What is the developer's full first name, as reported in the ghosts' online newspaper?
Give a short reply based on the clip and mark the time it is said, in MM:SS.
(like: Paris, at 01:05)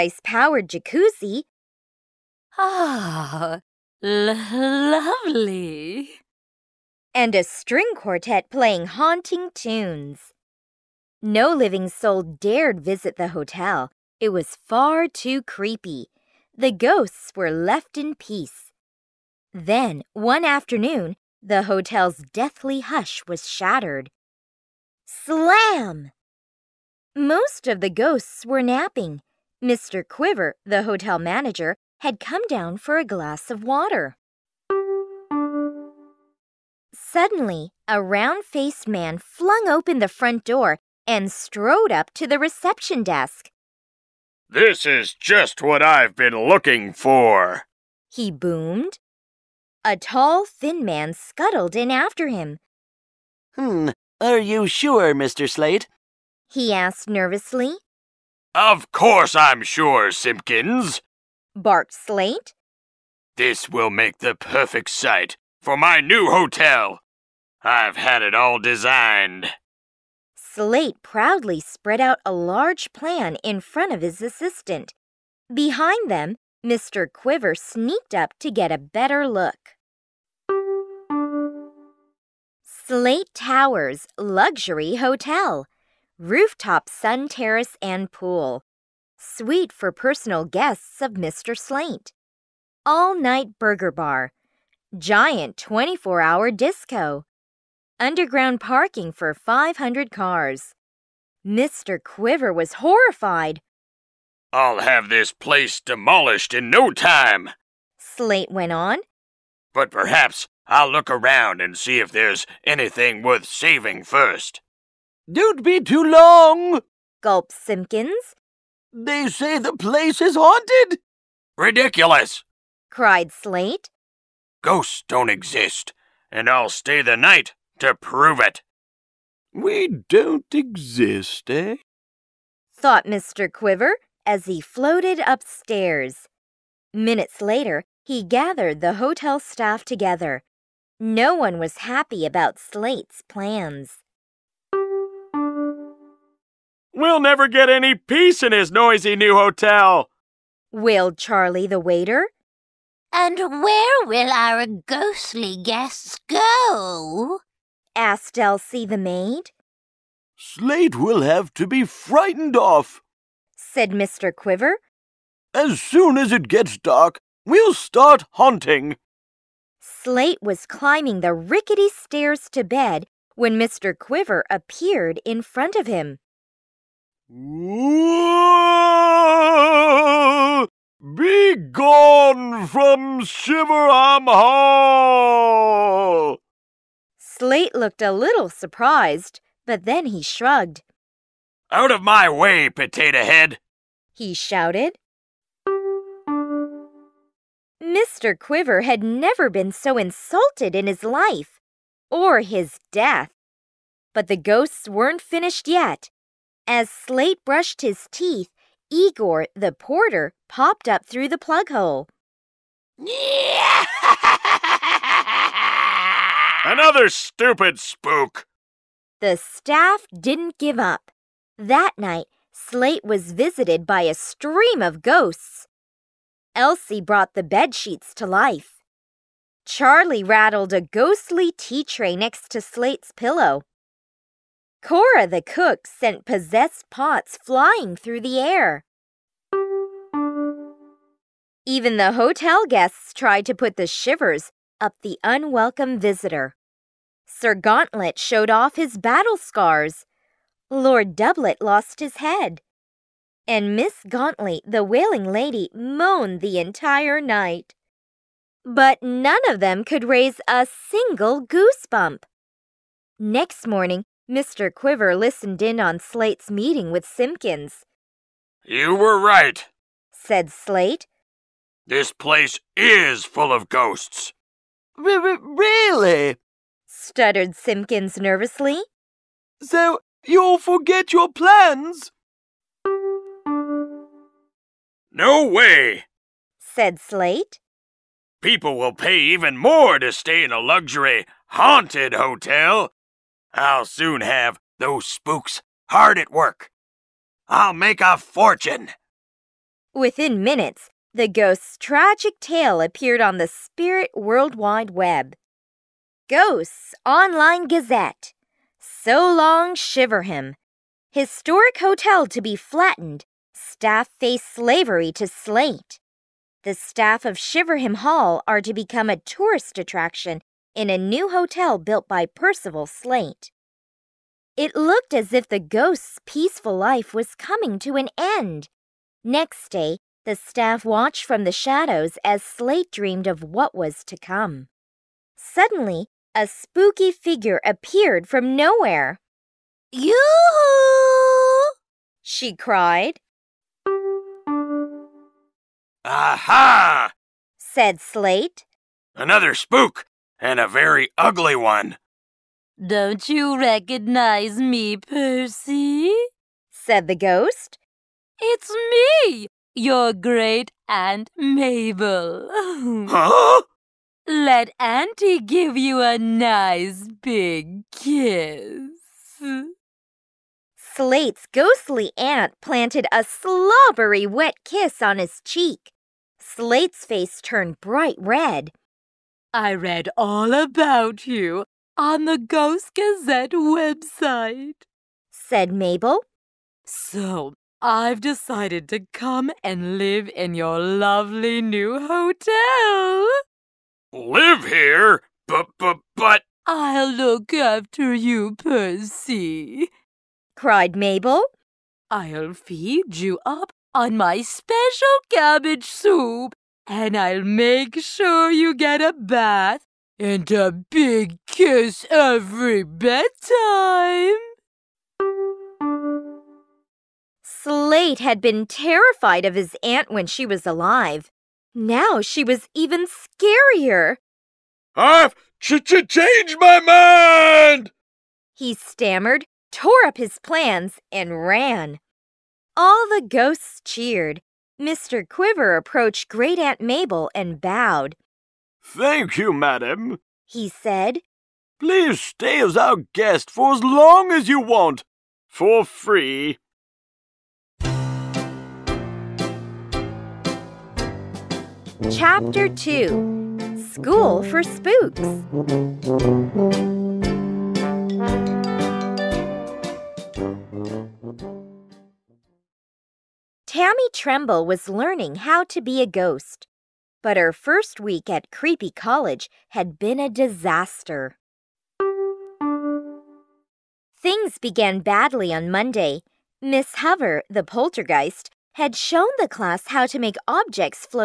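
Percival, at 05:22.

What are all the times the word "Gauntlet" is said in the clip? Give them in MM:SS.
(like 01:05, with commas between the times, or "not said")
04:07, 04:14.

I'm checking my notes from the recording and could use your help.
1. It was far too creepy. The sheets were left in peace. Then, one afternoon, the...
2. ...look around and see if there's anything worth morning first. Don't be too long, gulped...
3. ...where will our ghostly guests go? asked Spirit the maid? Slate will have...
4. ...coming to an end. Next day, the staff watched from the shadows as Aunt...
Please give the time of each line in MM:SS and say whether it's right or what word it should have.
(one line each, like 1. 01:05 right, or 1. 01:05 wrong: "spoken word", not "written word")
1. 00:14 wrong: "ghosts", not "sheets"
2. 01:50 wrong: "saving", not "morning"
3. 02:33 wrong: "Elsie", not "Spirit"
4. 05:27 wrong: "Slate", not "Aunt".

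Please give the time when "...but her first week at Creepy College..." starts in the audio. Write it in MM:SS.
07:47.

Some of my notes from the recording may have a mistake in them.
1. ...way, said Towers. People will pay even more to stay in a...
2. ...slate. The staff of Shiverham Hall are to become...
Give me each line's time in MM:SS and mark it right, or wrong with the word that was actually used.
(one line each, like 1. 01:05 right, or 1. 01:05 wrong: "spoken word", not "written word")
1. 04:45 wrong: "Slate", not "Towers"
2. 05:15 right.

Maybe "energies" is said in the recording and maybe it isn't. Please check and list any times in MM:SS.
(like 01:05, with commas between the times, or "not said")
not said.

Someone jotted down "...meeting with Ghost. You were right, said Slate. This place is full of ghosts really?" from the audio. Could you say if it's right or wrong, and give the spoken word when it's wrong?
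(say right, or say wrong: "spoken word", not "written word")
wrong: "Simpkins", not "Ghost".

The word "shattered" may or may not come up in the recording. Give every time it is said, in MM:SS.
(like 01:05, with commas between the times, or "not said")
00:23.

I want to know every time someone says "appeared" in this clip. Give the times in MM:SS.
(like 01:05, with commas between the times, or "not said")
02:54, 05:02, 05:37.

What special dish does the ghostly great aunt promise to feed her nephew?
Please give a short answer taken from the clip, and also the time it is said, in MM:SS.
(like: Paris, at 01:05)
cabbage soup, at 06:45.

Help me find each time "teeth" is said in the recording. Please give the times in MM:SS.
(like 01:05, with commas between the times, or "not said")
03:28.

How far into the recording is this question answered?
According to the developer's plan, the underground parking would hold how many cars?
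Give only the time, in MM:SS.
01:39.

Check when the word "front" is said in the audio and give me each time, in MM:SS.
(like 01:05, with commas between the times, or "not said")
00:40, 01:13, 02:55.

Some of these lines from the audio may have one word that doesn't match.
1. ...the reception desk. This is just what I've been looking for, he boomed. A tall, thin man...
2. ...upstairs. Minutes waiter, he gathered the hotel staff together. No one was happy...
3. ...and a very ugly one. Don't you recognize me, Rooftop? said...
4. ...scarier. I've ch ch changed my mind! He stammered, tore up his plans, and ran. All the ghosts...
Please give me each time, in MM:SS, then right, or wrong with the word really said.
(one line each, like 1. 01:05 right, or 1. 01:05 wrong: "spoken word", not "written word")
1. 00:42 right
2. 02:15 wrong: "later", not "waiter"
3. 05:50 wrong: "Percy", not "Rooftop"
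4. 07:03 right.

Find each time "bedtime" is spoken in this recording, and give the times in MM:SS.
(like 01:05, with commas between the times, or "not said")
06:52.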